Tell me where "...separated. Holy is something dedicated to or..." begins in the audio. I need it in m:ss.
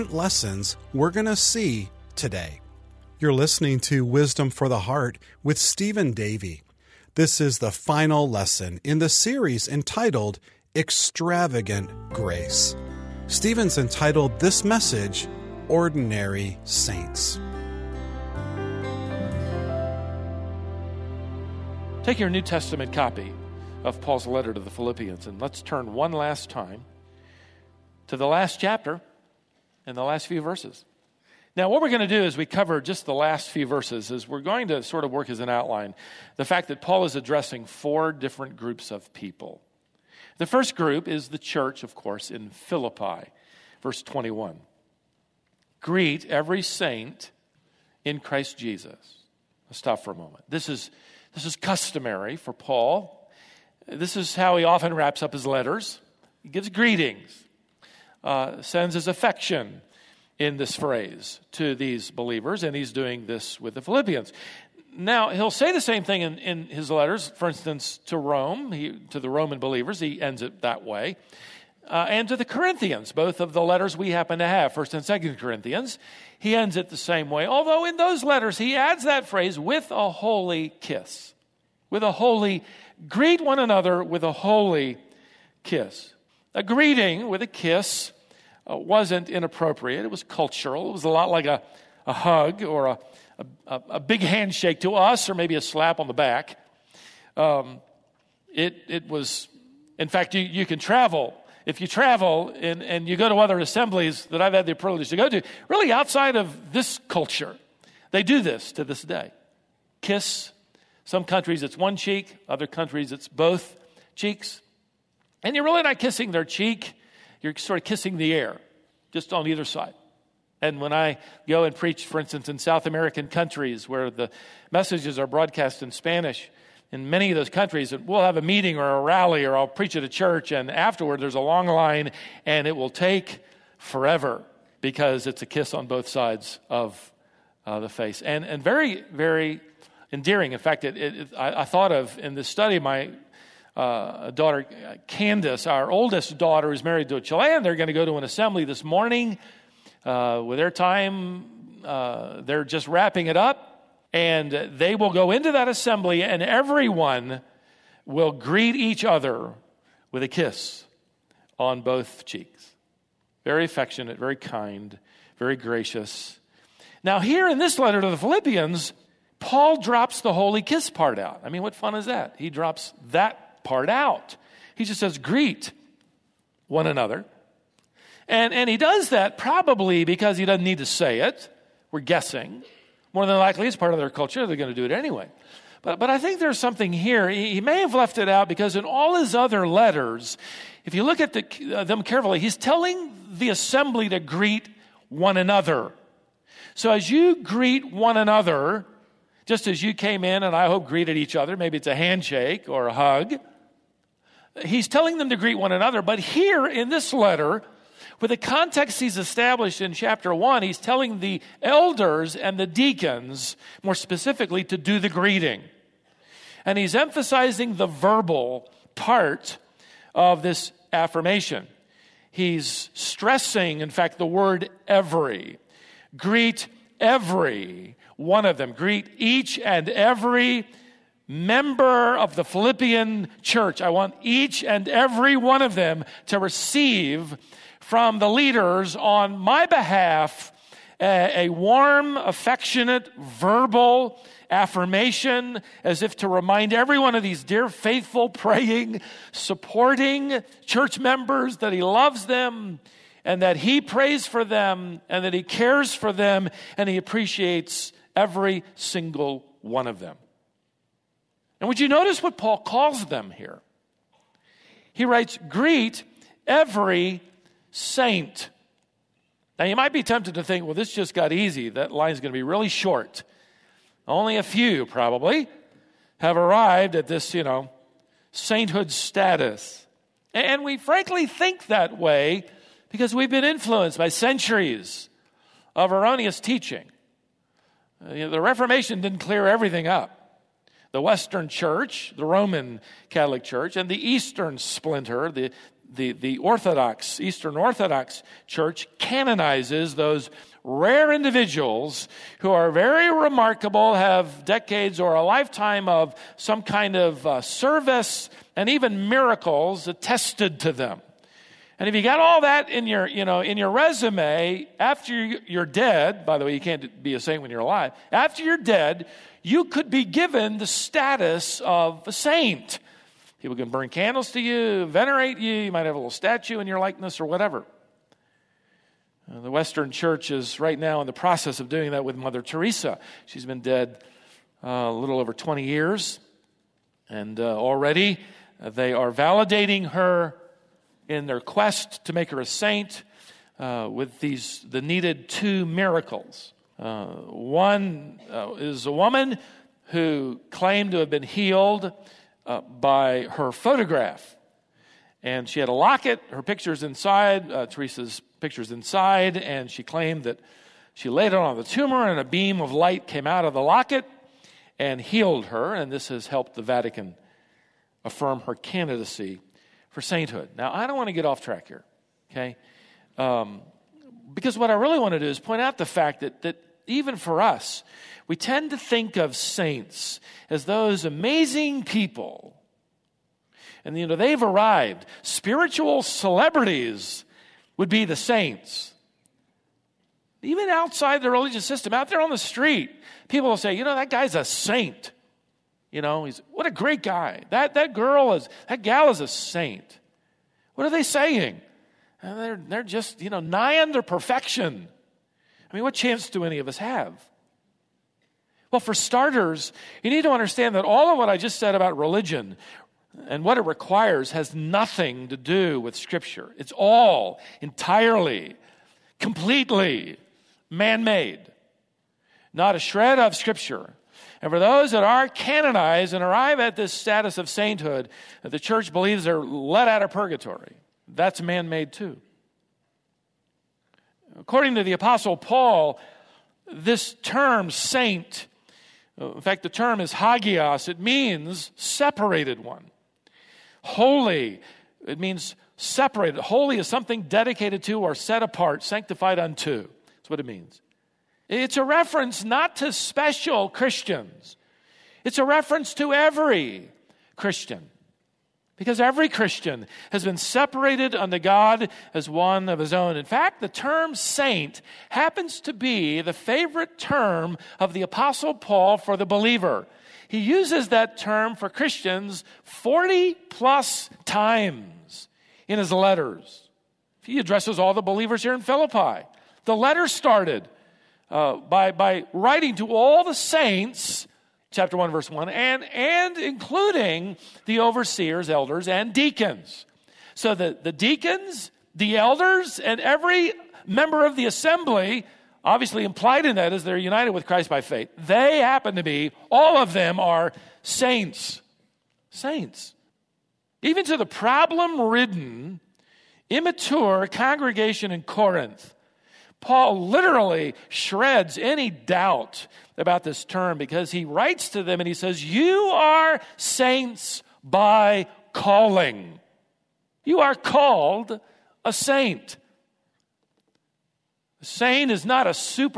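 7:25.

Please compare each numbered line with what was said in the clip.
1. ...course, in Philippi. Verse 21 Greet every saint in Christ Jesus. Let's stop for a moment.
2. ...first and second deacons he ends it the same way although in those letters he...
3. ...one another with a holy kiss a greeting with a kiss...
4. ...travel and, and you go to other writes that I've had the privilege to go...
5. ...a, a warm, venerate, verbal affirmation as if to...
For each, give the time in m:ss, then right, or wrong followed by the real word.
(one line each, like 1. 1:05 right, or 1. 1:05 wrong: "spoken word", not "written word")
1. 0:41 right
2. 1:14 wrong: "corinthians", not "deacons"
3. 1:23 right
4. 1:41 wrong: "assemblies", not "writes"
5. 4:01 wrong: "affectionate", not "venerate".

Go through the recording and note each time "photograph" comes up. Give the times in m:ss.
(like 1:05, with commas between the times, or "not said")
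5:53.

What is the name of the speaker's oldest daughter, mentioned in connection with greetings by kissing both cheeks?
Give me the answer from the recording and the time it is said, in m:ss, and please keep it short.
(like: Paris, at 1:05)
Candace, at 2:25.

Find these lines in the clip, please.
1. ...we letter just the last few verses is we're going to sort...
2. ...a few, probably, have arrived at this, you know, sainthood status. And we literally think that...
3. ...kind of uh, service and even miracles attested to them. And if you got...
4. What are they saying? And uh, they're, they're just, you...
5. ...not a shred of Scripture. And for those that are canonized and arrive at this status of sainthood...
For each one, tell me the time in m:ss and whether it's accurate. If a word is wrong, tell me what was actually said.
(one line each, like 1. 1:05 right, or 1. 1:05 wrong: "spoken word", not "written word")
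1. 0:32 wrong: "cover", not "letter"
2. 4:34 wrong: "frankly", not "literally"
3. 5:06 right
4. 6:40 right
5. 7:02 right.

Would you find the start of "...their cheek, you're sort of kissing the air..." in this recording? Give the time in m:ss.
1:56.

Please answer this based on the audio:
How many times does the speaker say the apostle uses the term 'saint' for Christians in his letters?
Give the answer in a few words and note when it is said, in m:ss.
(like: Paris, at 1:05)
40 plus, at 7:52.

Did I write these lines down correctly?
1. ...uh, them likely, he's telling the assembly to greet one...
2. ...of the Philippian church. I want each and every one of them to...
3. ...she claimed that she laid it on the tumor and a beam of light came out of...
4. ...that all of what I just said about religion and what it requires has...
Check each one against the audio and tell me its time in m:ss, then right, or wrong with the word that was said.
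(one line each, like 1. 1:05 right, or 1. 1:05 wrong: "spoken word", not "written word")
1. 3:11 wrong: "carefully", not "likely"
2. 3:52 right
3. 5:59 right
4. 6:50 right.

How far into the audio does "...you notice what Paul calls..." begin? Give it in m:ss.
4:21.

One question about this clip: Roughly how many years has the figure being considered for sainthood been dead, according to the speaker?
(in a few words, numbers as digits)
20.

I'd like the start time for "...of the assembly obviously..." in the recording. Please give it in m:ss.
8:14.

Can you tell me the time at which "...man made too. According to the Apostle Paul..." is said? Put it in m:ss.
7:11.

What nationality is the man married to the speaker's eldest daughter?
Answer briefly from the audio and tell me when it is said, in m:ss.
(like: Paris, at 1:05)
Chilean, at 2:27.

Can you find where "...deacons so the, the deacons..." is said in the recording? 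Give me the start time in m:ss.
8:09.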